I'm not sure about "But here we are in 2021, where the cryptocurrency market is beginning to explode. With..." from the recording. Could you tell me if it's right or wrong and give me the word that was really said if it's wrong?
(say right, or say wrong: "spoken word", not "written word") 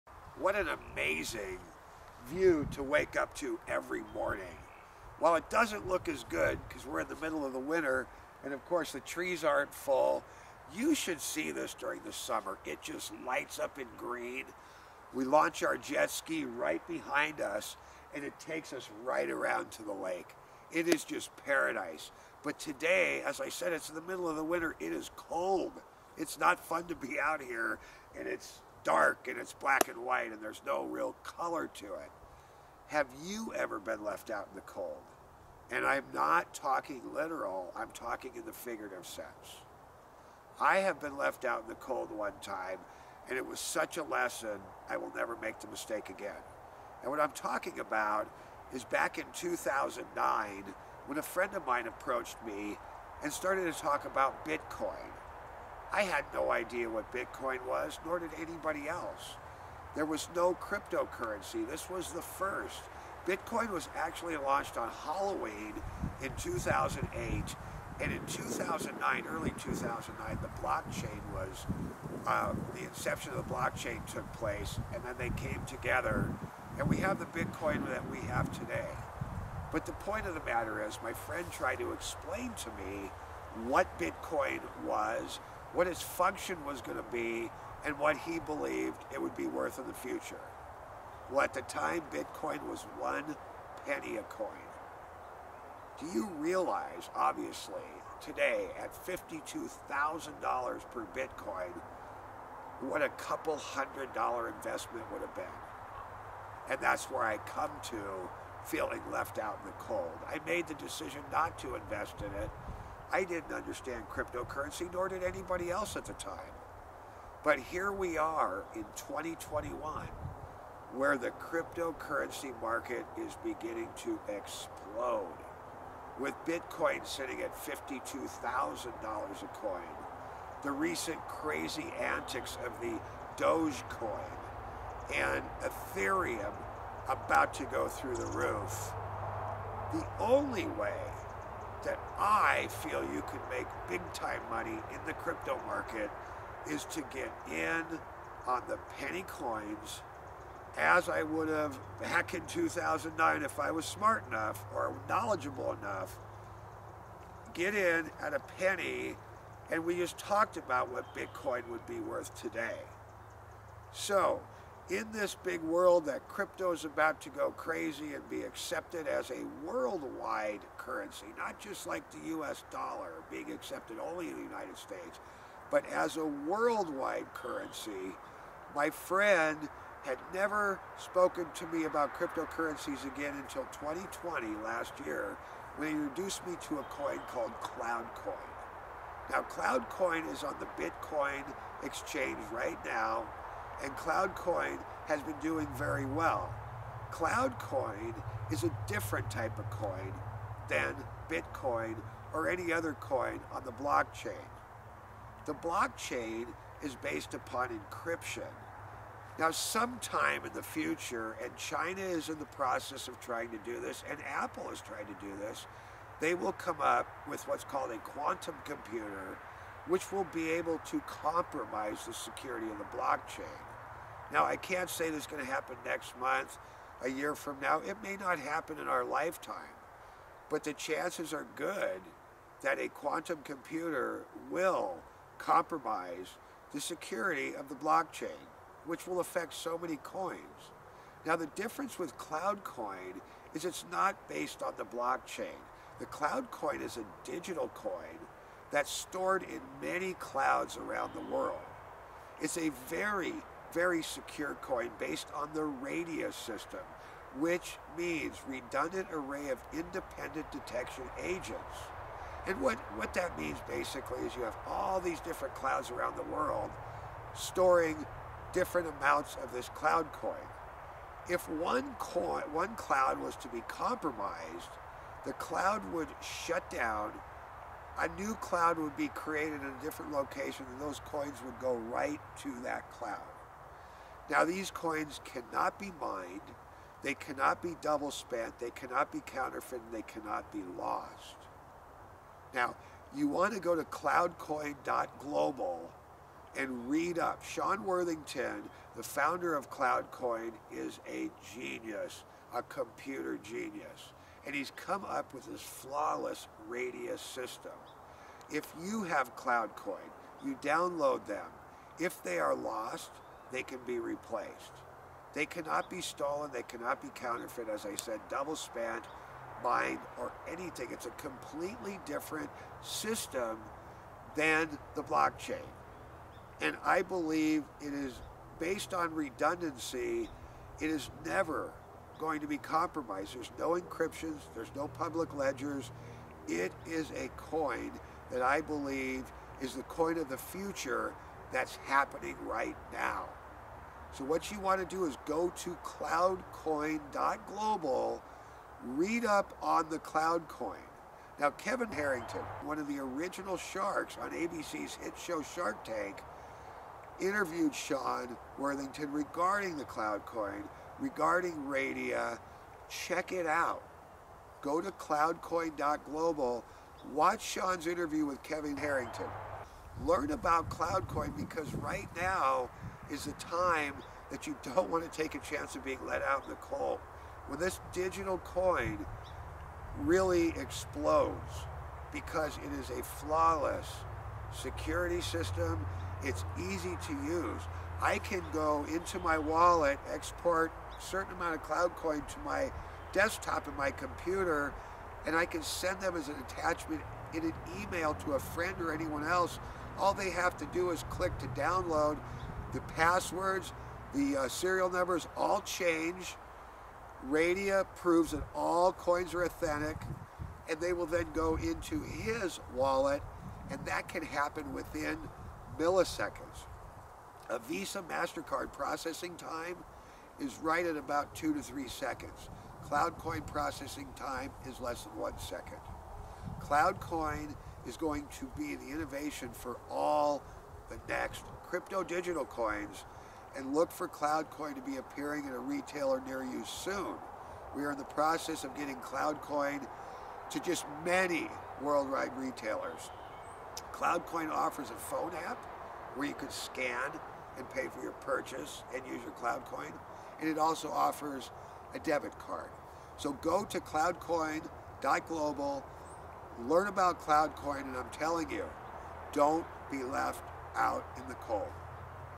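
right.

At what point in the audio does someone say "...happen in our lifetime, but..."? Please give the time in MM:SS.
03:48.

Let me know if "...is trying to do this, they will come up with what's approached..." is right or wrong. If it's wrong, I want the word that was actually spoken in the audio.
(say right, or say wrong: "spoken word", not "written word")
wrong: "called", not "approached".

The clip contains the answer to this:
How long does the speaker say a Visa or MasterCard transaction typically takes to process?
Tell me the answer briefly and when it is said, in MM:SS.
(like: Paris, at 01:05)
2 to 3 seconds, at 07:01.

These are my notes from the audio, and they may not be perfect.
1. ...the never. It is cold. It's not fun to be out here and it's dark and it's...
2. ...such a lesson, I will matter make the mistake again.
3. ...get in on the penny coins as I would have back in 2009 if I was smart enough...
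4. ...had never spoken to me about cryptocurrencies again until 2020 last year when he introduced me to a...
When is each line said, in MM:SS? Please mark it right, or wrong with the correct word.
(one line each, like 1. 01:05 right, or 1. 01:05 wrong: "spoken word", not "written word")
1. 00:24 wrong: "winter", not "never"
2. 00:43 wrong: "never", not "matter"
3. 02:27 right
4. 03:00 right.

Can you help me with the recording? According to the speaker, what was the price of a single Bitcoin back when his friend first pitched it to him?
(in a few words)
1 penny.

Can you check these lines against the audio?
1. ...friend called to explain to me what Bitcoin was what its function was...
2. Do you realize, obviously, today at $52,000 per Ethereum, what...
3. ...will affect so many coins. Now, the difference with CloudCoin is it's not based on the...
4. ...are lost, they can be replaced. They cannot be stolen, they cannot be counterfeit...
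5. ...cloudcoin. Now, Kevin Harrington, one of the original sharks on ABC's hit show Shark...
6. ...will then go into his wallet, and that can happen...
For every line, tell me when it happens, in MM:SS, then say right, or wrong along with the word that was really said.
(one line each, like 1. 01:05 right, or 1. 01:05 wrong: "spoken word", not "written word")
1. 01:21 wrong: "tried", not "called"
2. 01:35 wrong: "Bitcoin", not "Ethereum"
3. 03:59 right
4. 05:12 right
5. 05:49 right
6. 06:50 right.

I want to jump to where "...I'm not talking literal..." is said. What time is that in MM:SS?
00:35.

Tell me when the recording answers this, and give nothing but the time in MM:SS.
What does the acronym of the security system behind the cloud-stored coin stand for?
04:18.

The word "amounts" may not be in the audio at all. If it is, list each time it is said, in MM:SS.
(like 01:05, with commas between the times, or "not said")
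04:28, 06:31.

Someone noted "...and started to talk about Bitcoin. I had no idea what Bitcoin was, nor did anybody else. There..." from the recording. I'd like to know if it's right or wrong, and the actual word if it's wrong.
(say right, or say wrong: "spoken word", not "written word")
right.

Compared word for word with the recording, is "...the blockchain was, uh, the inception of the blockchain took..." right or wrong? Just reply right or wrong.
right.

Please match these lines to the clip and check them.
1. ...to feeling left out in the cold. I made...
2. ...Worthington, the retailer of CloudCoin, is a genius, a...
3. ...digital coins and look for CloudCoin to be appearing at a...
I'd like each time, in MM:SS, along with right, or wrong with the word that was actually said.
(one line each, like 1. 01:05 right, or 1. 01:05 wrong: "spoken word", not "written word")
1. 01:47 right
2. 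04:57 wrong: "founder", not "retailer"
3. 07:12 right.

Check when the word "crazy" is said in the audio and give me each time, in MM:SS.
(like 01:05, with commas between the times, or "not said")
02:11, 02:47.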